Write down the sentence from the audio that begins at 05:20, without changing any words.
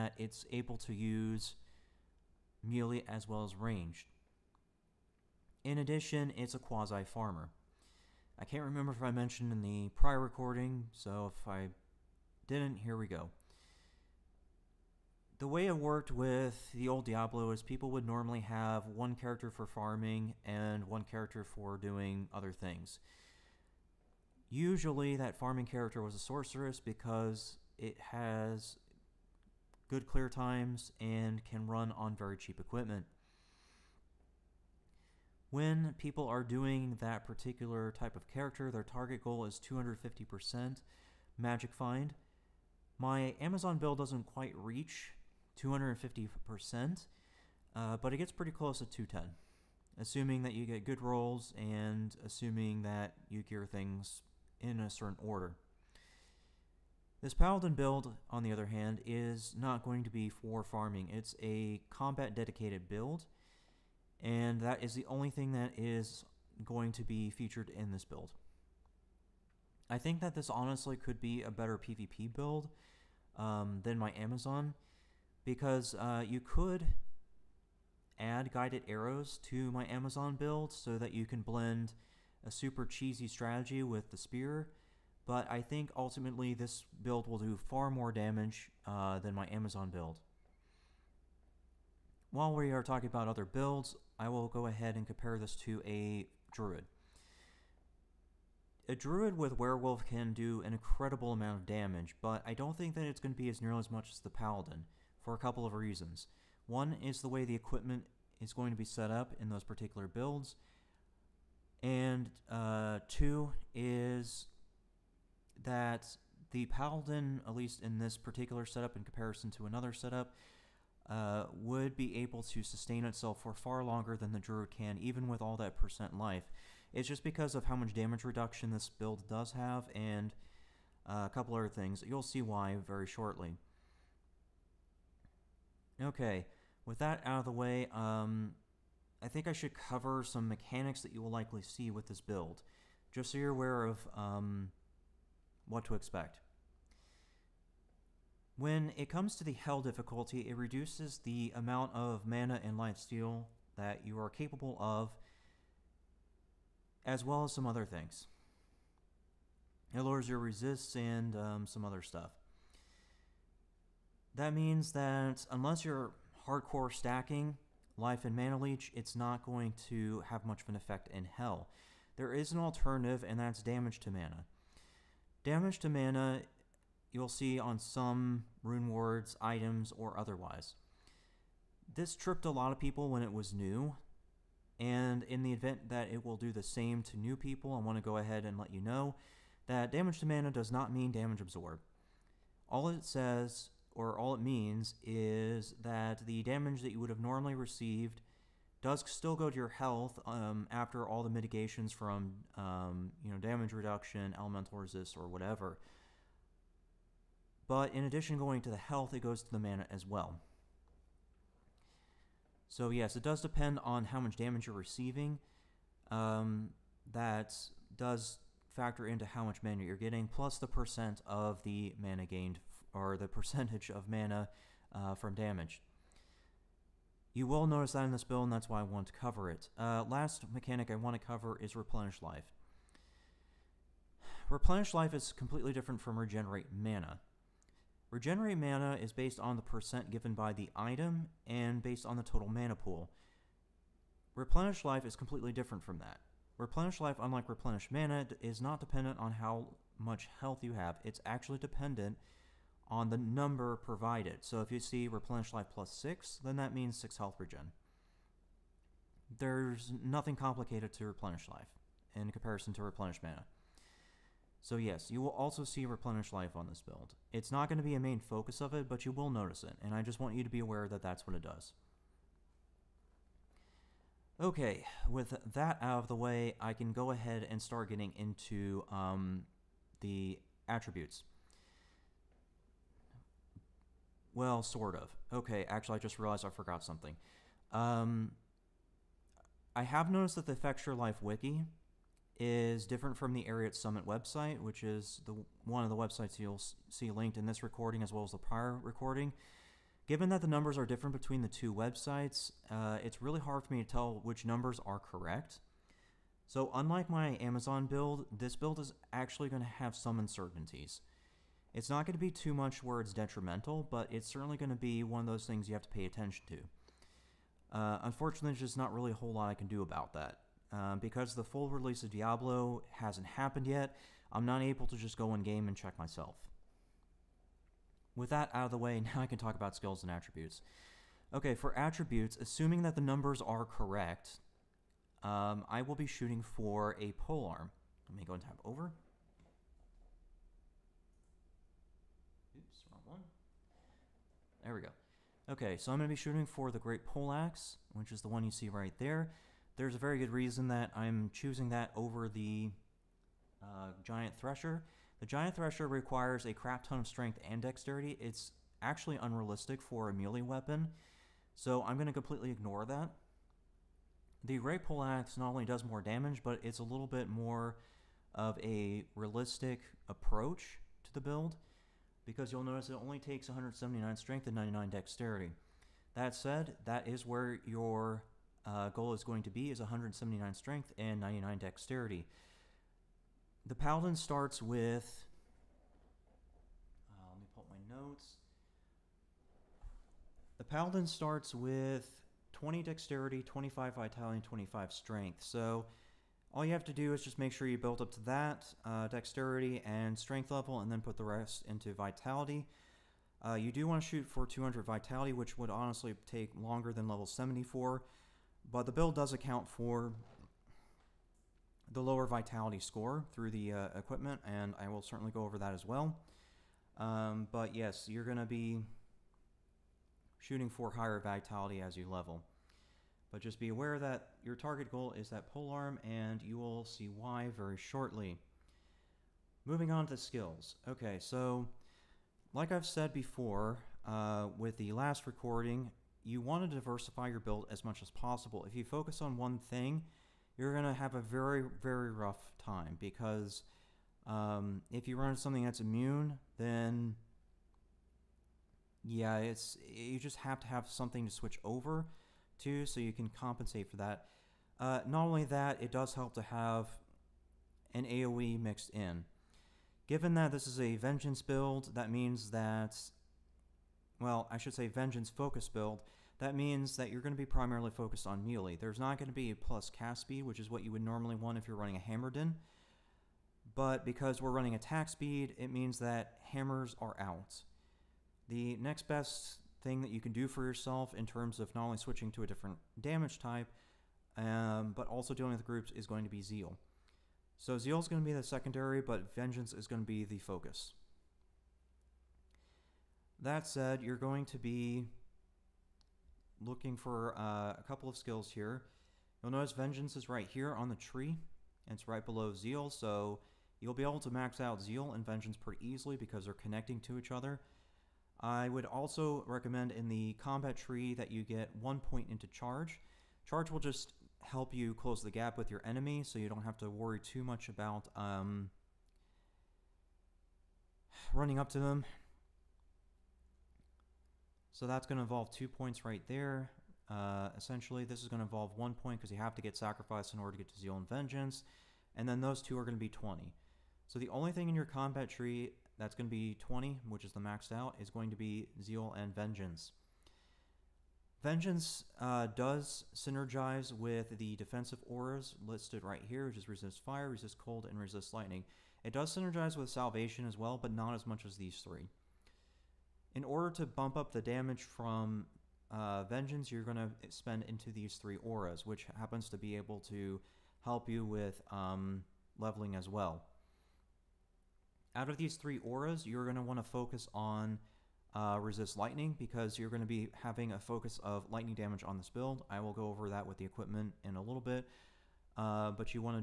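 Um, because the full release of Diablo hasn't happened yet, I'm not able to just go in game and check myself.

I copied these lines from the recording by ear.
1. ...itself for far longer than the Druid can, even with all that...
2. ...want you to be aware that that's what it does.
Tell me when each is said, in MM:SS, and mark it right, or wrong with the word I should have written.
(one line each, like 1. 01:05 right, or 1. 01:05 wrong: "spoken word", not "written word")
1. 02:03 right
2. 04:30 right.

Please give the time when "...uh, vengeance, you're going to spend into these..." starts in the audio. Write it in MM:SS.
09:15.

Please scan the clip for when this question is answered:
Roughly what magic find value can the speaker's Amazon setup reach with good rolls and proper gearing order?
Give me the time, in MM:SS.
00:48.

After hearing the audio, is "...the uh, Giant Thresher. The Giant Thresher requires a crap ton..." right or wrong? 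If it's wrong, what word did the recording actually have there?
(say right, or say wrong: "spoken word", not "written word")
right.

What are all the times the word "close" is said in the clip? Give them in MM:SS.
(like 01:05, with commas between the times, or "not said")
00:48, 08:34.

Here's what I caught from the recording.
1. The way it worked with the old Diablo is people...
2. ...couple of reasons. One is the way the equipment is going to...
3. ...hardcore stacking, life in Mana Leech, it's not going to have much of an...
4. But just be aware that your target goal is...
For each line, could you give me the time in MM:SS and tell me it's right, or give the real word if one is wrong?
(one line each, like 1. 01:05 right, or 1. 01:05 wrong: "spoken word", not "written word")
1. 00:15 right
2. 01:45 right
3. 02:46 right
4. 07:03 right.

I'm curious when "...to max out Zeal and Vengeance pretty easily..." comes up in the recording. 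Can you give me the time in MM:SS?
08:24.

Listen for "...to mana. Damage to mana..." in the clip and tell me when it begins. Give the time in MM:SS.
02:54.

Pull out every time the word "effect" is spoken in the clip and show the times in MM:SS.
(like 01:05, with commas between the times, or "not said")
02:50.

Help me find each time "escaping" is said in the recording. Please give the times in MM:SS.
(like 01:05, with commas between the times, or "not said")
not said.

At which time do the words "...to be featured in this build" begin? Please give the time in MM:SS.
01:06.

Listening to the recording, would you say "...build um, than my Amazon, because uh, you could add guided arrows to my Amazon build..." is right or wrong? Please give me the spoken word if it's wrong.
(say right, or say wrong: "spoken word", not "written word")
right.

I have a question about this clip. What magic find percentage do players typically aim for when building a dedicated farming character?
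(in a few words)
250%.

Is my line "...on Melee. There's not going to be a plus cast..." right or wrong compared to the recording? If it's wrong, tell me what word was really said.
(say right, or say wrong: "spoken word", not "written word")
right.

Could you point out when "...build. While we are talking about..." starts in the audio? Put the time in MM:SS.
01:29.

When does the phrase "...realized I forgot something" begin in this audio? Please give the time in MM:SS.
04:46.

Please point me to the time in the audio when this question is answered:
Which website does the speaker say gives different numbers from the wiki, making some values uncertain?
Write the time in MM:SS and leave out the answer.
04:53.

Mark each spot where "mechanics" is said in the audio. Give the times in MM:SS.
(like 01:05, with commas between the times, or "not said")
02:20, 03:50.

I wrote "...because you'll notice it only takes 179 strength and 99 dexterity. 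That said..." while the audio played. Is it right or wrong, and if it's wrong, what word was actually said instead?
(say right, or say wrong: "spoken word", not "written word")
right.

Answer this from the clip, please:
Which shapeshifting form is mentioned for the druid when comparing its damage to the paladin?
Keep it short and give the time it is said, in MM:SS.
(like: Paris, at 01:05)
Werewolf, at 01:39.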